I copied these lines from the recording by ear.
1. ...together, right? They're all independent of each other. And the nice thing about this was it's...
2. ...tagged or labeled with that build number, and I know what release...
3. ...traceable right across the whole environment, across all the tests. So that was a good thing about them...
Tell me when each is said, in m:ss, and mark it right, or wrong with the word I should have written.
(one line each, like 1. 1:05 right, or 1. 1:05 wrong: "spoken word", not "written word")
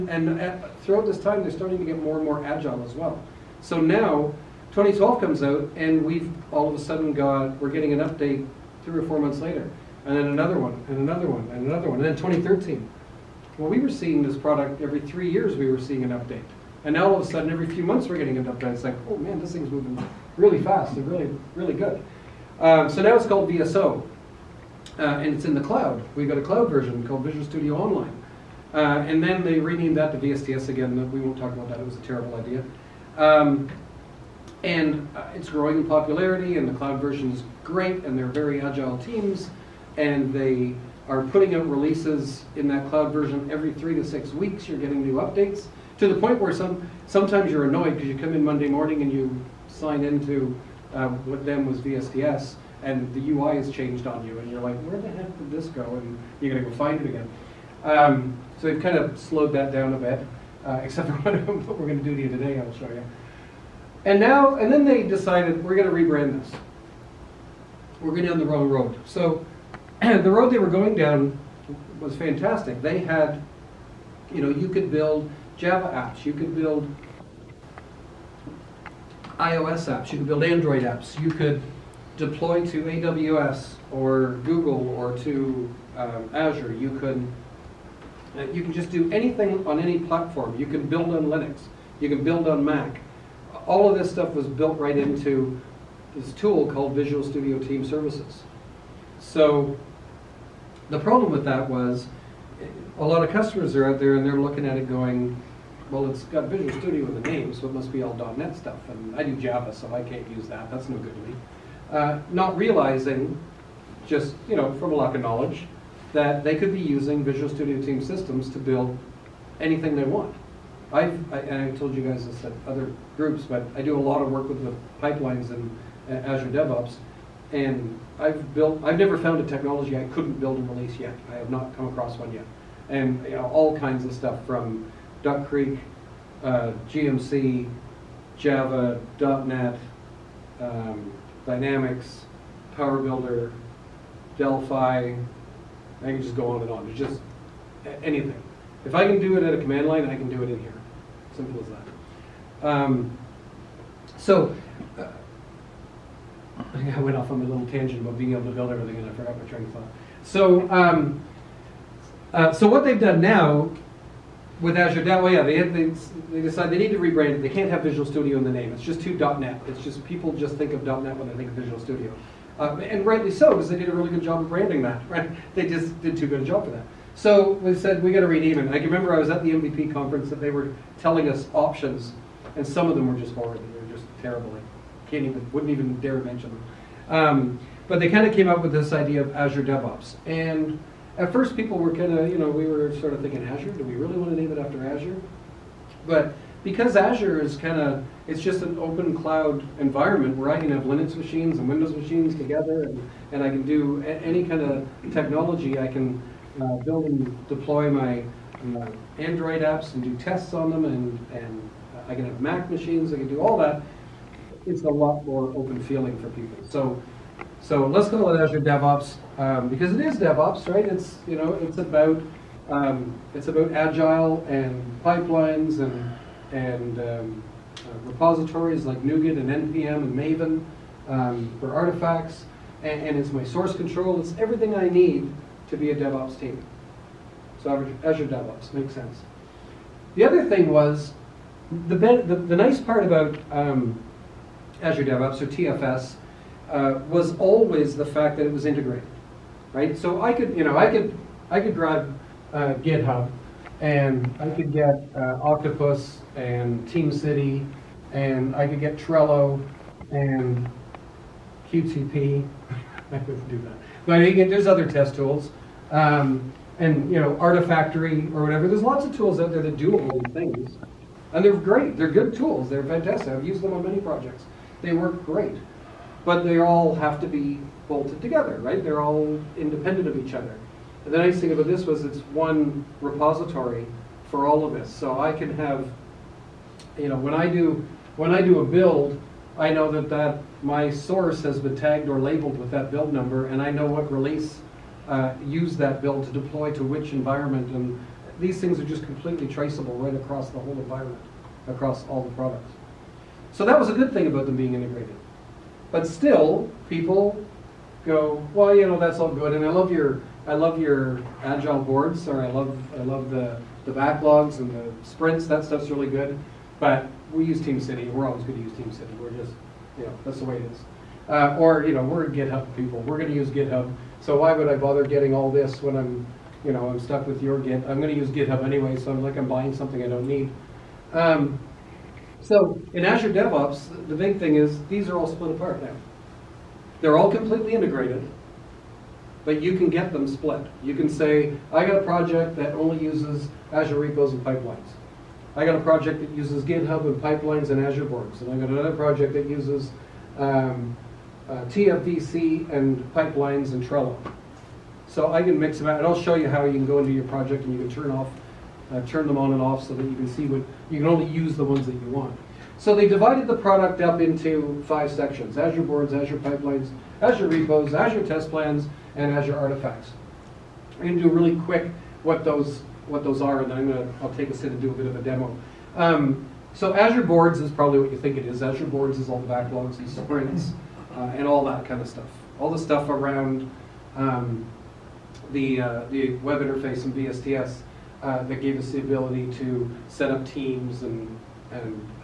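1. 4:38 right
2. 4:51 right
3. 4:59 wrong: "products", not "tests".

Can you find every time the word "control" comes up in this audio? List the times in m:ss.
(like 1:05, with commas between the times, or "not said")
3:53.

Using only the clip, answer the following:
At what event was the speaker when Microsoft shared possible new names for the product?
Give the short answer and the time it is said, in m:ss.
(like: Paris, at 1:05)
the MVP conference, at 2:59.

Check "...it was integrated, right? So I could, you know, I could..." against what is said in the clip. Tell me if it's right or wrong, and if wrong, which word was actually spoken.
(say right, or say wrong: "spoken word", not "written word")
right.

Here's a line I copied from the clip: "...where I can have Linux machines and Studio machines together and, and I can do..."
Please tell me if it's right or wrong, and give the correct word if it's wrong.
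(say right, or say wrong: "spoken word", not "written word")
wrong: "Windows", not "Studio".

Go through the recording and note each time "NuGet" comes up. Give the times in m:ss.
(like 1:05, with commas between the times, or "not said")
3:49.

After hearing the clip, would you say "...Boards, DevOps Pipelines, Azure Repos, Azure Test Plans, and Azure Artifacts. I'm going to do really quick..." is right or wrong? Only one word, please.
wrong.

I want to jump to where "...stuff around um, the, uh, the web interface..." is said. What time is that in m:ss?
6:22.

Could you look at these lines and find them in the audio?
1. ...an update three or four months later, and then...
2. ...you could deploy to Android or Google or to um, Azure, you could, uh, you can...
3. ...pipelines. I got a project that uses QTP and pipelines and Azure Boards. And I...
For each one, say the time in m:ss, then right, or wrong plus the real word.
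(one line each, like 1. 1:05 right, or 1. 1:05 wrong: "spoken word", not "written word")
1. 0:07 right
2. 1:21 wrong: "AWS", not "Android"
3. 5:44 wrong: "GitHub", not "QTP".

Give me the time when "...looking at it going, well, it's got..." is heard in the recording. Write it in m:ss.
1:44.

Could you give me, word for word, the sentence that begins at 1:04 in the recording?
And now, and then they decided we're gonna rebrand this.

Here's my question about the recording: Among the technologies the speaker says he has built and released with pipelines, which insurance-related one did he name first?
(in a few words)
Duck Creek.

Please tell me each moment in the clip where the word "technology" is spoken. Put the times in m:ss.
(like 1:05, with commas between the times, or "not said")
2:09, 3:25.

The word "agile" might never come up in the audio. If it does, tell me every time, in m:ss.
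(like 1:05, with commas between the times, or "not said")
0:02, 0:38, 3:43, 5:11.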